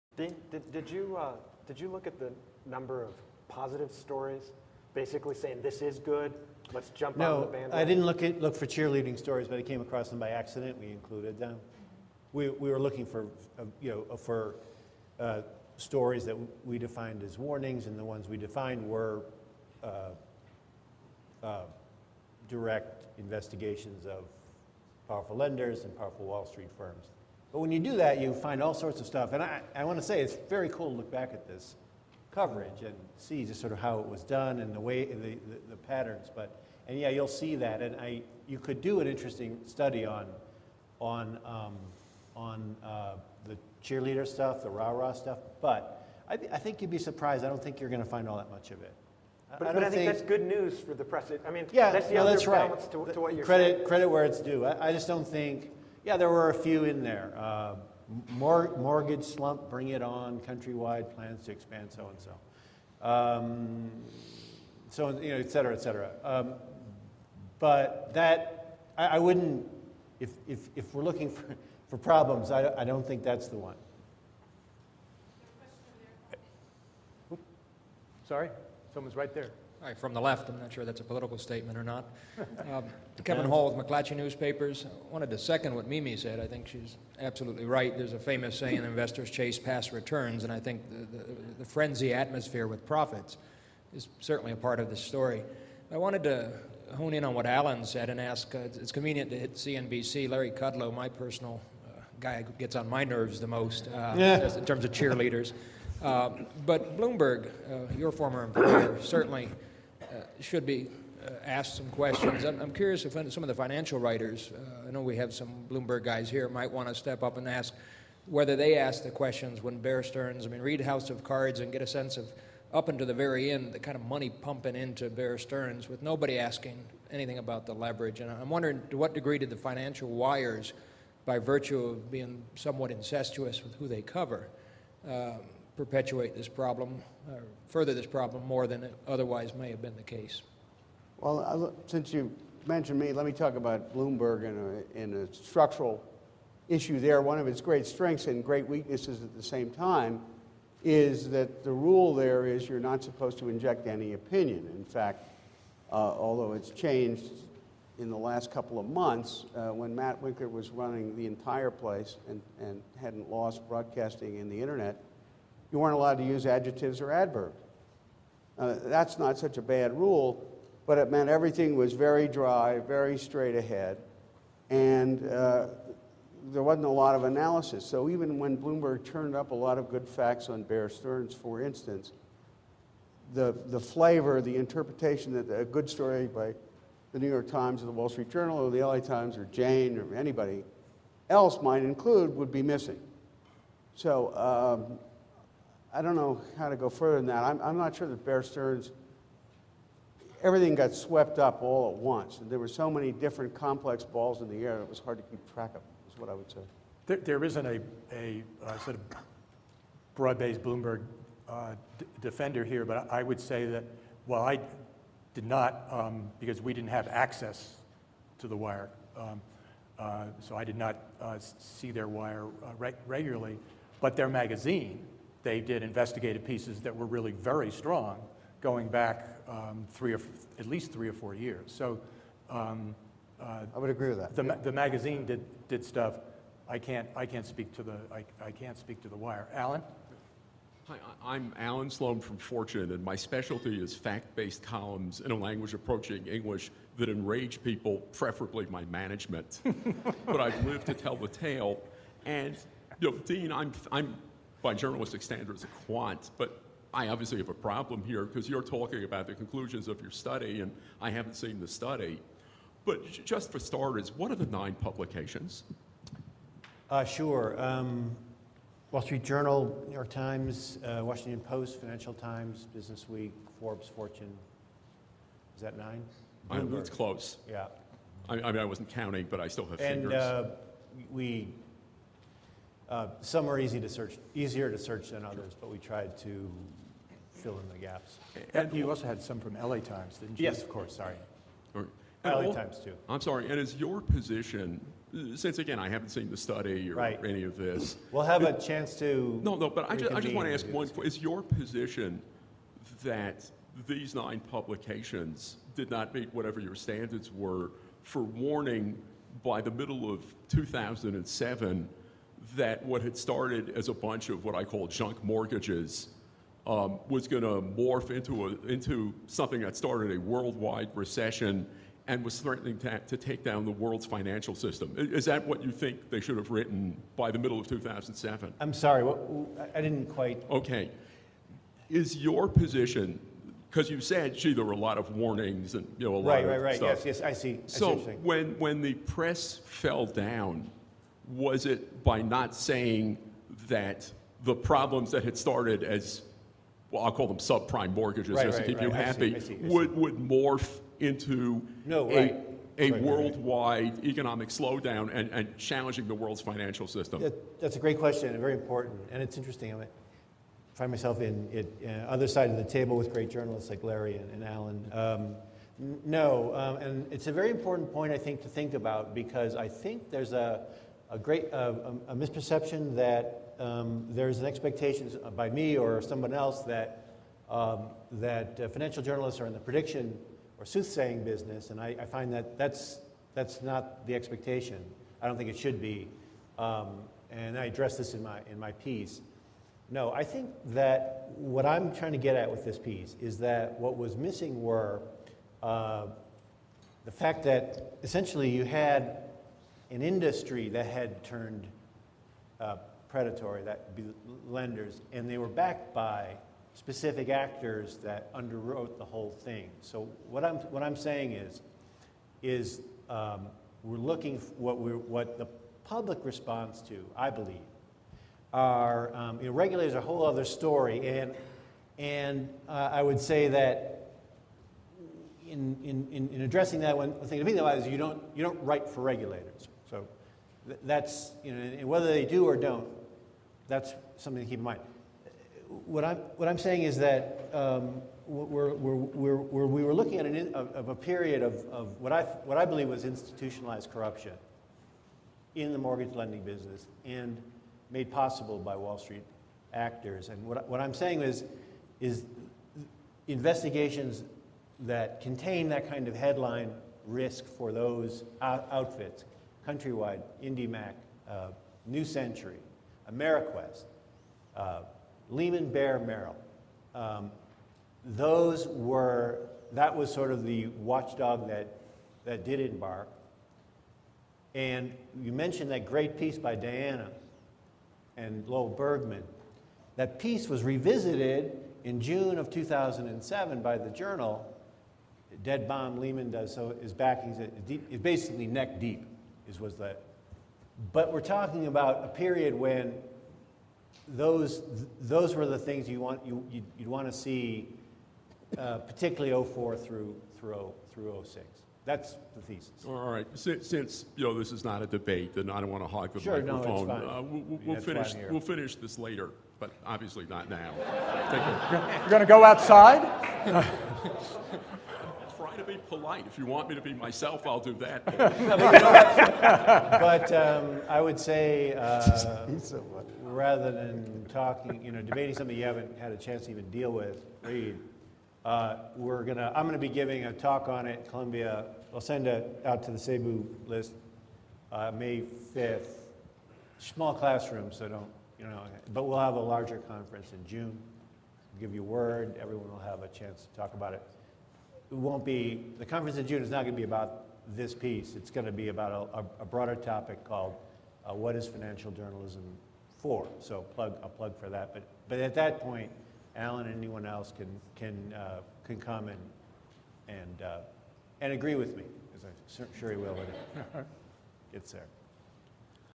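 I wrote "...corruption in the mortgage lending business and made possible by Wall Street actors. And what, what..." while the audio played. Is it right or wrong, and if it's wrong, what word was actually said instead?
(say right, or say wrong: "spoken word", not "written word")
right.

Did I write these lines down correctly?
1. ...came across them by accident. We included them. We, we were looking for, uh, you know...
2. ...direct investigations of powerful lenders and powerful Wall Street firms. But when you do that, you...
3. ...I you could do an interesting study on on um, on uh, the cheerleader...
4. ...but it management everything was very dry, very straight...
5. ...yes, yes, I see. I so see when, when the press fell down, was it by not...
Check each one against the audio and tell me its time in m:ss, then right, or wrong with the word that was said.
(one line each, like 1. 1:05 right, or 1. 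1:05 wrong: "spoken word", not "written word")
1. 0:09 right
2. 0:22 right
3. 0:37 right
4. 2:50 wrong: "meant", not "management"
5. 5:37 right.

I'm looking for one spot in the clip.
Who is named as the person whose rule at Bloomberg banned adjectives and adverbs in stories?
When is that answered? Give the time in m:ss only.
2:39.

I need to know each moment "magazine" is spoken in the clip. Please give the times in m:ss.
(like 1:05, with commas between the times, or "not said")
3:44, 3:54.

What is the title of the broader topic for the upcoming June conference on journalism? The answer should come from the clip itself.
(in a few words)
What is Financial Journalism for?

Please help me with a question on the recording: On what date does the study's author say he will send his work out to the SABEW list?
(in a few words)
May 5.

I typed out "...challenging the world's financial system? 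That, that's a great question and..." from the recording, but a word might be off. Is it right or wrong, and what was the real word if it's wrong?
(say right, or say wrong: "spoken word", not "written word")
right.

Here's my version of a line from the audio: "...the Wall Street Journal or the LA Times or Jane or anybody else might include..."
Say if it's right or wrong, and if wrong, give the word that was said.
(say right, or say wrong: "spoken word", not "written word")
right.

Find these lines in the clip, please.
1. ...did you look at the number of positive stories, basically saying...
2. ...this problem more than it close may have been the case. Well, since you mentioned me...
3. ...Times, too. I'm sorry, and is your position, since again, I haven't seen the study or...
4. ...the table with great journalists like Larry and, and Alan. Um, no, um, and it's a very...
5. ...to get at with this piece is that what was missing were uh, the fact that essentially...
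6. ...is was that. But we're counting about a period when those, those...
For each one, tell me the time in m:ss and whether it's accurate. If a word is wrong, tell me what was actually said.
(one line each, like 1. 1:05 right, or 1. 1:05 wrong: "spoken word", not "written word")
1. 0:01 right
2. 2:17 wrong: "otherwise", not "close"
3. 4:52 right
4. 6:02 right
5. 6:32 right
6. 8:09 wrong: "talking", not "counting".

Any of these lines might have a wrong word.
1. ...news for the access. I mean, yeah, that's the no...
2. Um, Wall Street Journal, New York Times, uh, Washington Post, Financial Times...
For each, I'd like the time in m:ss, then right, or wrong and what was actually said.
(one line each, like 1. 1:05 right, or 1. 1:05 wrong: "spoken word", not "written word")
1. 0:50 wrong: "press", not "access"
2. 4:27 right.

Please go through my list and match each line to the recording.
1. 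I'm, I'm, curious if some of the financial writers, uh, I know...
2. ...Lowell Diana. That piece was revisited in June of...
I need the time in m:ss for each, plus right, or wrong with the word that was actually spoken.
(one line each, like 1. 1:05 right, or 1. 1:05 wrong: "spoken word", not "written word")
1. 1:52 right
2. 7:58 wrong: "Bergman", not "Diana".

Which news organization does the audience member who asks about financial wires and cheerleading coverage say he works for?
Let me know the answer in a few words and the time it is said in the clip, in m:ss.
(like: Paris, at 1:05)
McClatchy Newspapers, at 1:23.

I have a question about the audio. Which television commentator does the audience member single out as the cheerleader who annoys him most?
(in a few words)
Larry Kudlow.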